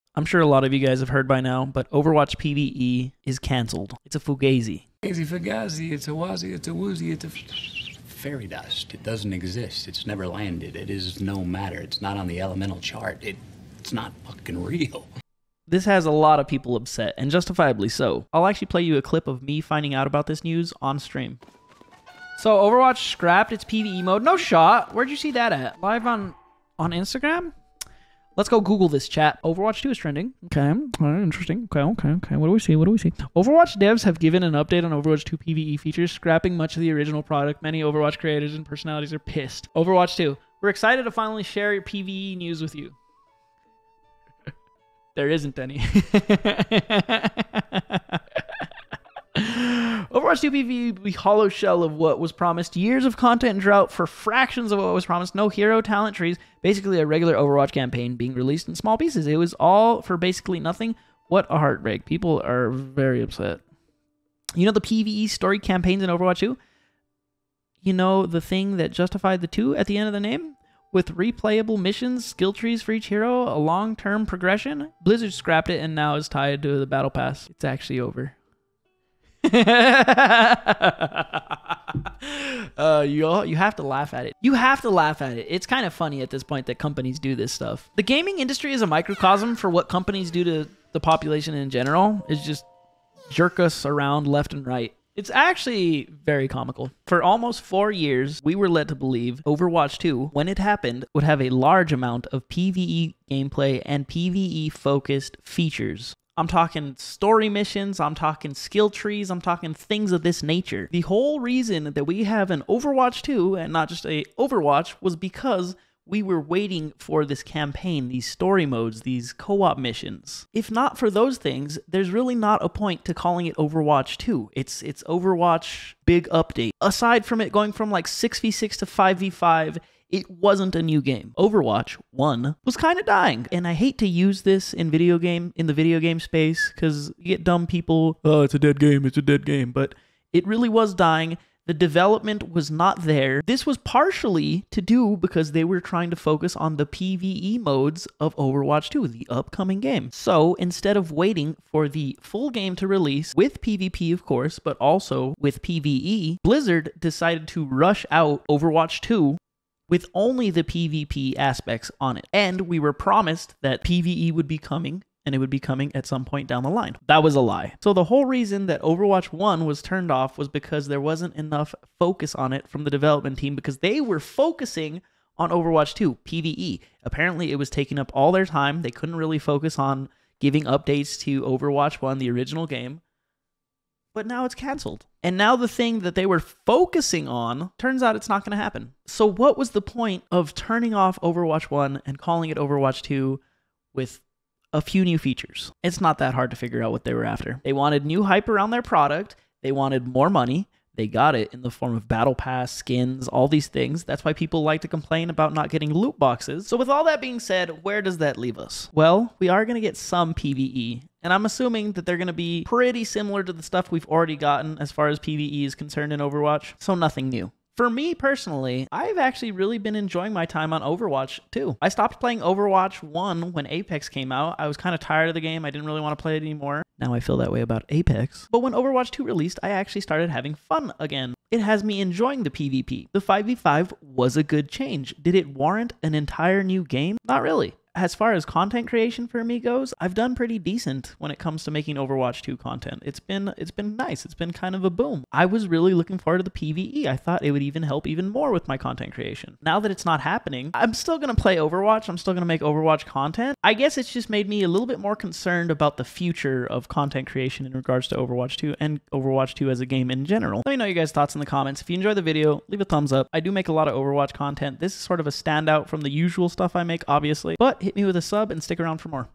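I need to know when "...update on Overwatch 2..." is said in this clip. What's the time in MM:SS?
00:34.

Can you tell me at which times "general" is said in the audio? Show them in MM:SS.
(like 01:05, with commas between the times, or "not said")
01:31, 04:20.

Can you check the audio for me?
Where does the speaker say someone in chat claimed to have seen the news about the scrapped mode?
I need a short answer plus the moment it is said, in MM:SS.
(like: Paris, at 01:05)
Instagram, at 00:26.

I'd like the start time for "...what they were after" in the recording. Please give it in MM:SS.
03:16.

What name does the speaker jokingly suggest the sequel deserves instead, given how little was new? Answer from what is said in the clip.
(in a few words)
Overwatch Big Update.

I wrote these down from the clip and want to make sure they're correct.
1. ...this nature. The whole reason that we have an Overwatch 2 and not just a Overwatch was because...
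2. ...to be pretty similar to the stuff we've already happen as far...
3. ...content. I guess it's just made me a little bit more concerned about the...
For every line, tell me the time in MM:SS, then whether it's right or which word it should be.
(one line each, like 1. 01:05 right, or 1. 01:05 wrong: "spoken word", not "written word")
1. 01:50 right
2. 03:32 wrong: "gotten", not "happen"
3. 04:13 right.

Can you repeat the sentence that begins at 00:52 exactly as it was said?
Years of content drought for fractions of what was promised.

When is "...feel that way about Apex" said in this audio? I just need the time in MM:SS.
03:47.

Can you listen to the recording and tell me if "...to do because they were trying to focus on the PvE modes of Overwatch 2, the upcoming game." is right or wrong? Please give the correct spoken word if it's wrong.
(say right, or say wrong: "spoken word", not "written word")
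right.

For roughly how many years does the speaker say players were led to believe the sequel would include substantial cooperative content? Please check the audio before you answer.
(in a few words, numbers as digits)
4.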